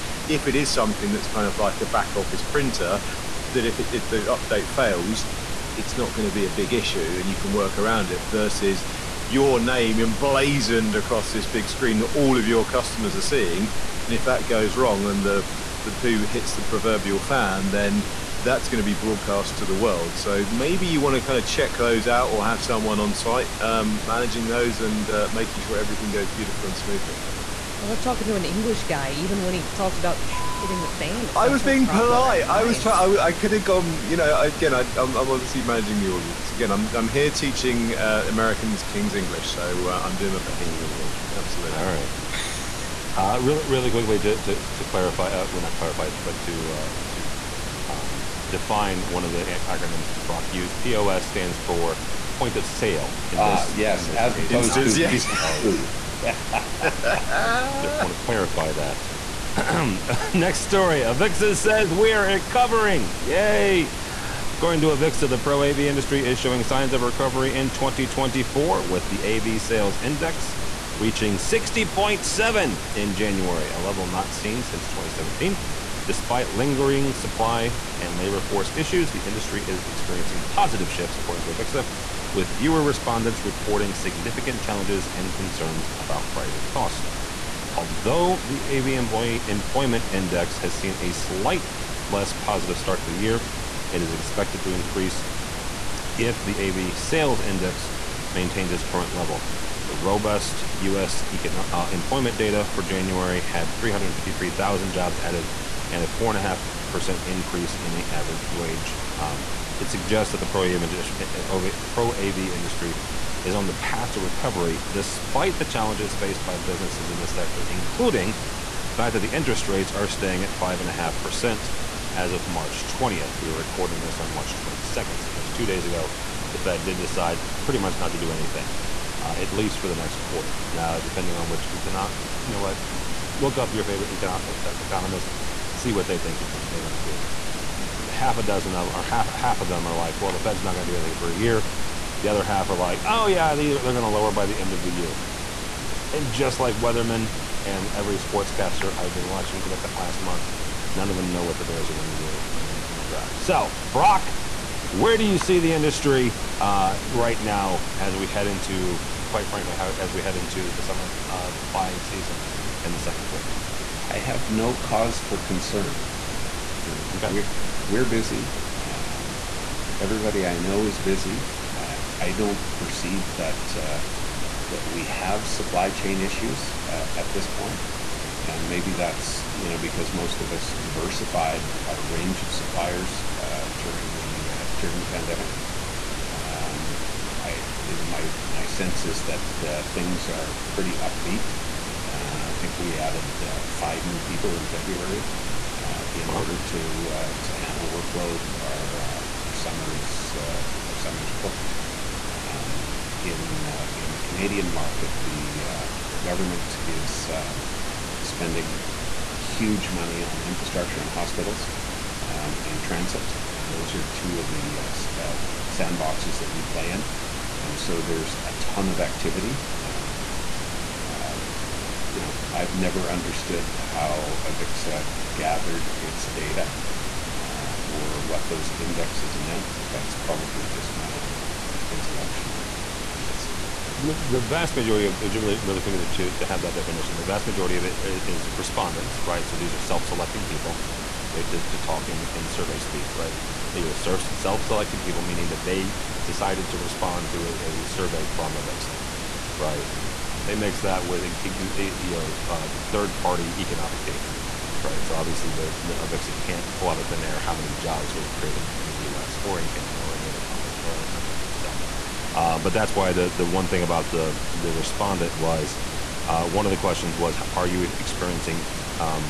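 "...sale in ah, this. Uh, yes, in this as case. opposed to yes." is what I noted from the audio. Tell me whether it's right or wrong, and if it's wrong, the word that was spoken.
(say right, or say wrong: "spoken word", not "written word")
right.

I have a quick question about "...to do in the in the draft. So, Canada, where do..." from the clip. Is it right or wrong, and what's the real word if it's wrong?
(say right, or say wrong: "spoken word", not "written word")
wrong: "Brock", not "Canada".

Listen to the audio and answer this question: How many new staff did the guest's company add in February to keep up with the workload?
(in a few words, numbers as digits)
5.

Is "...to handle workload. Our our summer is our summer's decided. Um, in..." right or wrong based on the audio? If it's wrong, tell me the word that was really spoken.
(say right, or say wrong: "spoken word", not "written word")
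wrong: "booked", not "decided".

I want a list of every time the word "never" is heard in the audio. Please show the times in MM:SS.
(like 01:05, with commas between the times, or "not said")
03:42.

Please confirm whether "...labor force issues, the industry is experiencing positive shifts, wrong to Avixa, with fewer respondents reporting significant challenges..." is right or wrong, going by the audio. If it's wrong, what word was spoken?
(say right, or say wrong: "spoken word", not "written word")
wrong: "according", not "wrong".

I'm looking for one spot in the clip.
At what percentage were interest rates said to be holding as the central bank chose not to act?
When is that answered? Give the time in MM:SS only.
02:00.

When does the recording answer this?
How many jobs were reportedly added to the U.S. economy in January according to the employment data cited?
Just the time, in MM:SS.
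01:43.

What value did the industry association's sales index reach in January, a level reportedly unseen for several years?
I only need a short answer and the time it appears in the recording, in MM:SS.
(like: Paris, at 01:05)
60.7, at 01:11.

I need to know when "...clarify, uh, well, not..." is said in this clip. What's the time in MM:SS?
00:44.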